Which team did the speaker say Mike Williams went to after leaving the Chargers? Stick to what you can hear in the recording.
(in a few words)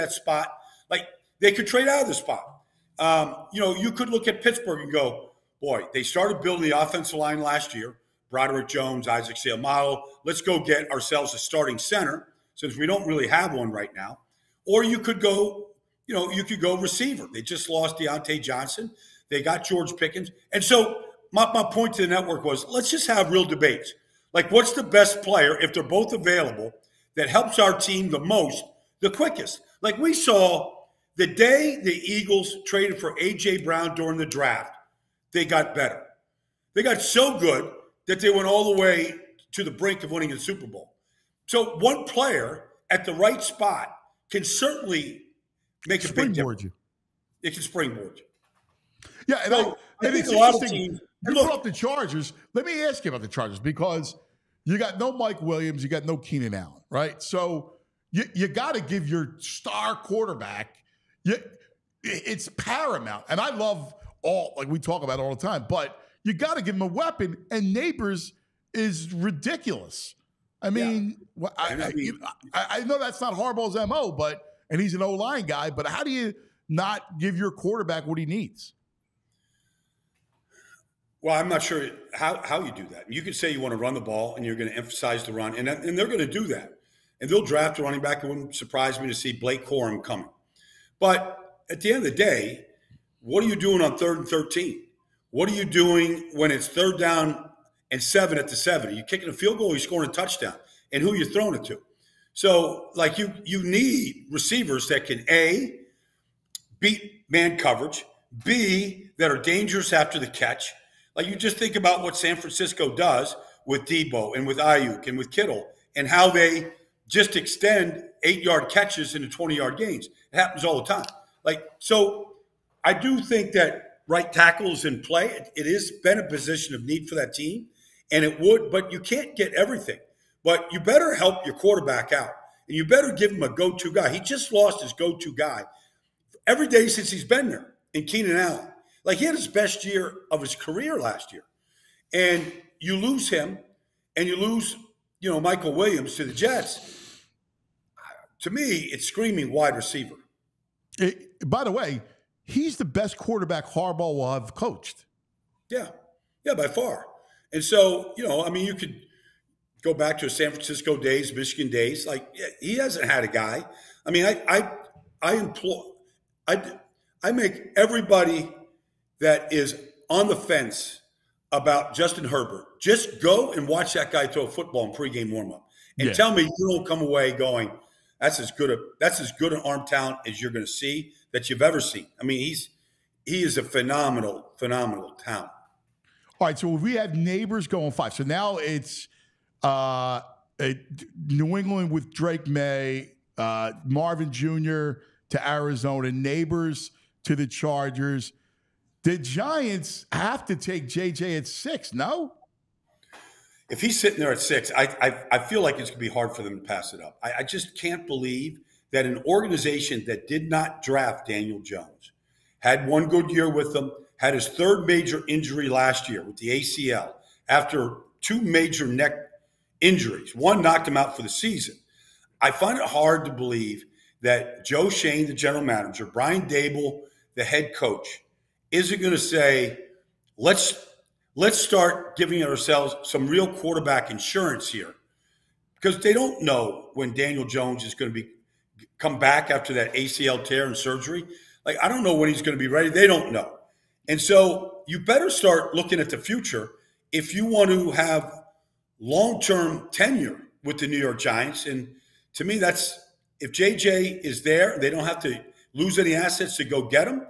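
The Jets.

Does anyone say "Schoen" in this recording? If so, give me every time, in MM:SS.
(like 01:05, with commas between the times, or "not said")
03:44.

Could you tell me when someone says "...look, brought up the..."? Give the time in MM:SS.
00:51.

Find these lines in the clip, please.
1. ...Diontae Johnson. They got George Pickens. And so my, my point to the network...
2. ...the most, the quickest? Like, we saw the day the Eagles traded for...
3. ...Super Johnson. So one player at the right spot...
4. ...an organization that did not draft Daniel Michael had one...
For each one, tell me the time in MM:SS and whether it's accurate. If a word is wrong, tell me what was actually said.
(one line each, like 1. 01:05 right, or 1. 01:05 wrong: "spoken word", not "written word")
1. 00:17 right
2. 00:28 right
3. 00:40 wrong: "Bowl", not "Johnson"
4. 03:29 wrong: "Jones", not "Michael".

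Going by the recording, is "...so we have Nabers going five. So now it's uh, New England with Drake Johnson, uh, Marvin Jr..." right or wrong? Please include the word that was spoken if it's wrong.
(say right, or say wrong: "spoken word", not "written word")
wrong: "Maye", not "Johnson".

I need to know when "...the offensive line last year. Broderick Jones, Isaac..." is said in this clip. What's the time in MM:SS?
00:06.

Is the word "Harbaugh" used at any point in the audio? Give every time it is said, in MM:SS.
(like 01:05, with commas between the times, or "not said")
01:13, 02:33.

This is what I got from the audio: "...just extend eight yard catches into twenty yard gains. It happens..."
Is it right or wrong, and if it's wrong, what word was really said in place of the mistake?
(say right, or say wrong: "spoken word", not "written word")
right.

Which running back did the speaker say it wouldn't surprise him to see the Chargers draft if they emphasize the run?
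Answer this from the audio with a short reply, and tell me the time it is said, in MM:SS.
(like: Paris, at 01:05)
Blake Corum, at 01:29.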